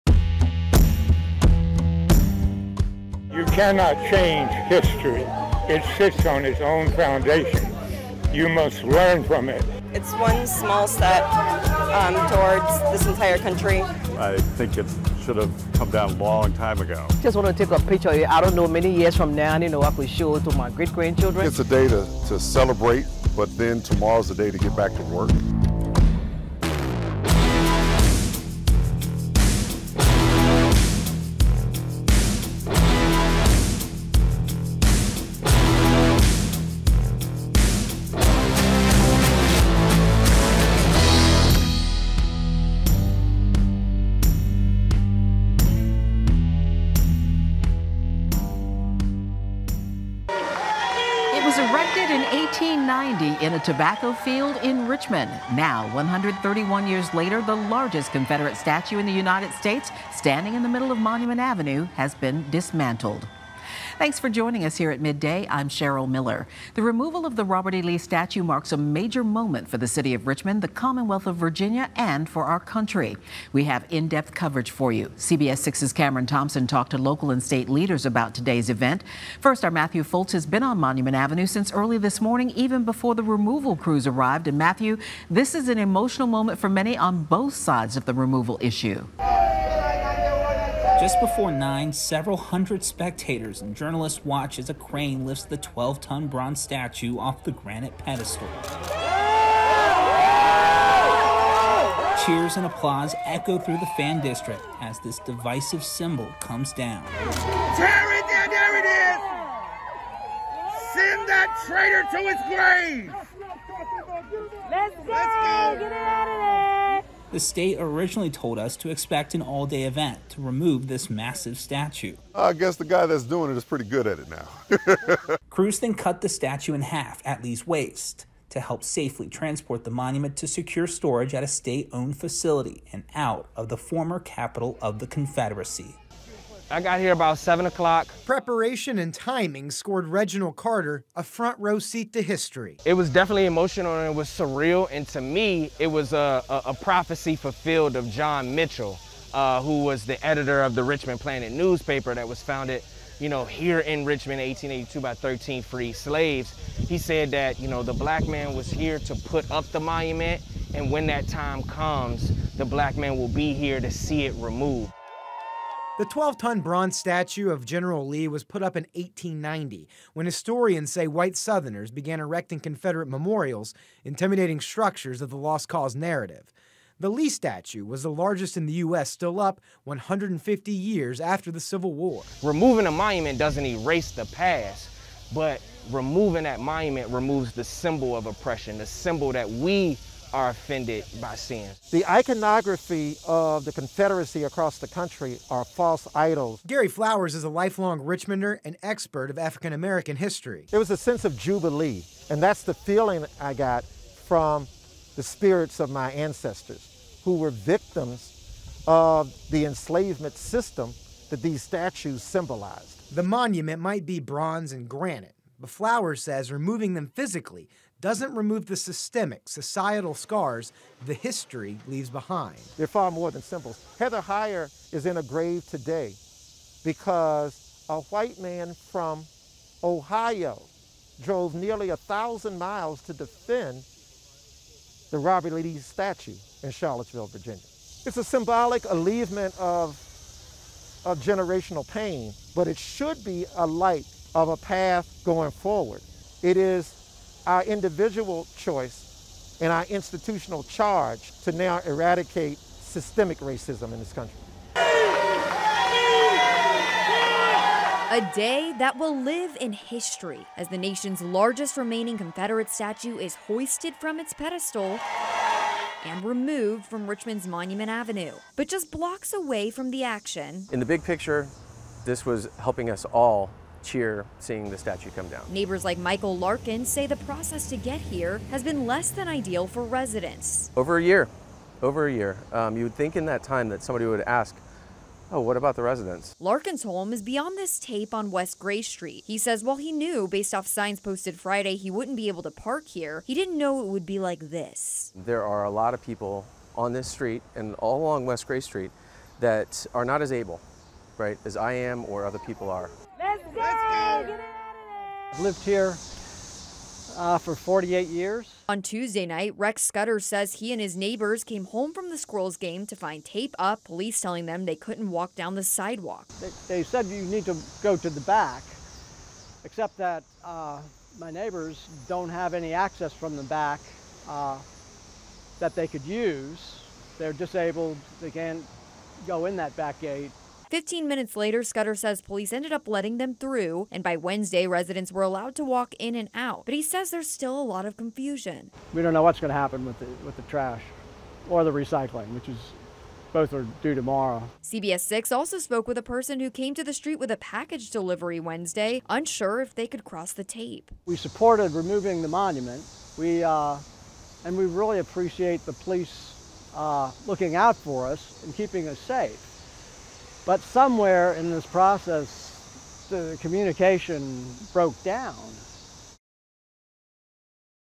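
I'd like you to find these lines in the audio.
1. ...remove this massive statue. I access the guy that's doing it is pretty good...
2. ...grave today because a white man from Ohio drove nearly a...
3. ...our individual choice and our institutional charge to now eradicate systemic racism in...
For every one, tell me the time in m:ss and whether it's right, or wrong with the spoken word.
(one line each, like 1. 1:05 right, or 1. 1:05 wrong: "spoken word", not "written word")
1. 2:00 wrong: "guess", not "access"
2. 3:45 right
3. 4:07 right.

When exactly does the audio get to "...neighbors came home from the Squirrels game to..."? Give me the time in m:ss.
5:10.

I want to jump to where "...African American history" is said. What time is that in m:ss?
3:19.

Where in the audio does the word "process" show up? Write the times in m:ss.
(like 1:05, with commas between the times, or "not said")
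4:37, 6:01.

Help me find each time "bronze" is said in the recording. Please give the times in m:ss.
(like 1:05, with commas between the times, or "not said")
1:36, 2:46, 3:34.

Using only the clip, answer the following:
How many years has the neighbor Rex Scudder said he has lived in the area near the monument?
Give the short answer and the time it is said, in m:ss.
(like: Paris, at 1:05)
48, at 5:07.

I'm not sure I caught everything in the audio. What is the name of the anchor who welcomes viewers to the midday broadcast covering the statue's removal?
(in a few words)
Cheryl Miller.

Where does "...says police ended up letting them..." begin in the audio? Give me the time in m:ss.
5:31.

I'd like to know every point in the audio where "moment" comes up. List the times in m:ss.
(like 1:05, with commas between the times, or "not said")
1:09, 1:26.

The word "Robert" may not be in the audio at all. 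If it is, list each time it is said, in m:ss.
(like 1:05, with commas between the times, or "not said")
1:07, 3:55.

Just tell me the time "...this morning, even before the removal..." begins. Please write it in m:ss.
1:21.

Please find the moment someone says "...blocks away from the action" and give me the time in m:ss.
4:28.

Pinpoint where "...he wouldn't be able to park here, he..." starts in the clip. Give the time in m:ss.
4:51.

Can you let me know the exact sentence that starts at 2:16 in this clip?
I got here about 7 o'clock.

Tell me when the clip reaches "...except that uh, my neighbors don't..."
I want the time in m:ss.
5:19.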